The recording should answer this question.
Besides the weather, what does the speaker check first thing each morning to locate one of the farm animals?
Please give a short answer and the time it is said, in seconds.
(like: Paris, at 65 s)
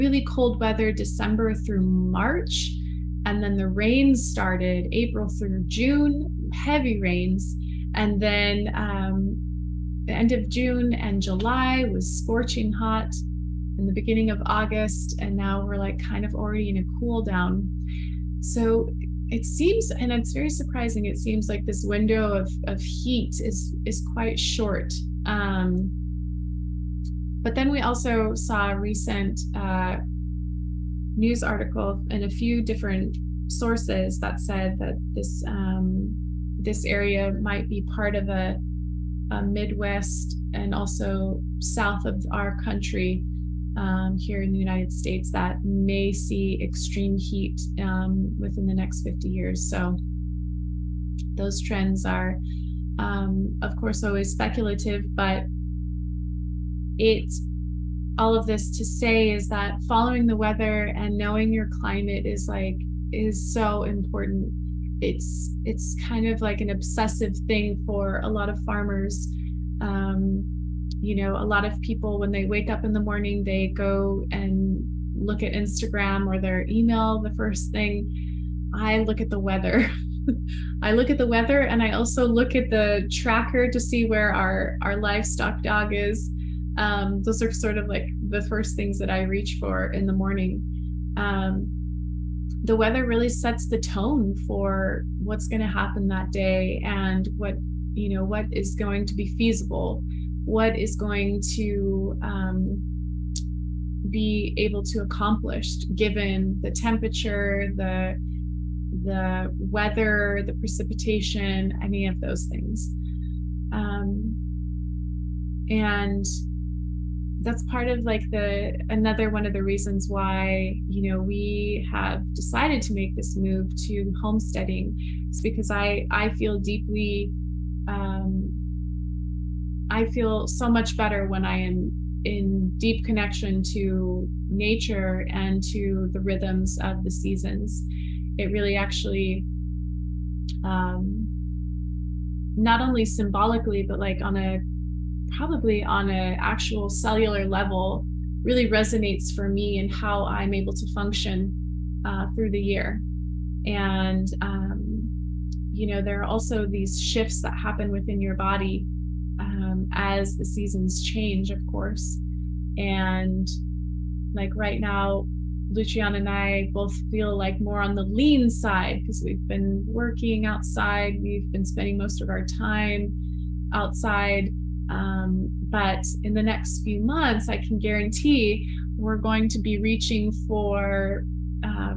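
The tracker, at 82 s.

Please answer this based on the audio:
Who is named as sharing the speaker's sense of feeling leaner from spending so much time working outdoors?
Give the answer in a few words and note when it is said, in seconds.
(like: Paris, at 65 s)
Luciana, at 165 s.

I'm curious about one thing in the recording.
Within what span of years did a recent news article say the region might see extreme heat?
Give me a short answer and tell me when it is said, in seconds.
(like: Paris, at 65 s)
50 years, at 49 s.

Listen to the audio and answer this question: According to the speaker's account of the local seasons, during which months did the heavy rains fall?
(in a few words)
April through June.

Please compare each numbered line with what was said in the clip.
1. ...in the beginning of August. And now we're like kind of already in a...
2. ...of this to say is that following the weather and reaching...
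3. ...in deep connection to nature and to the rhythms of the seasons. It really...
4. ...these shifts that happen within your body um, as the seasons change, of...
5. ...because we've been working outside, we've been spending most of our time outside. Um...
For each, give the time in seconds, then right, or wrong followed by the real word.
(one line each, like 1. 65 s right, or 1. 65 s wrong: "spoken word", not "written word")
1. 13 s right
2. 58 s wrong: "knowing", not "reaching"
3. 132 s right
4. 156 s right
5. 168 s right.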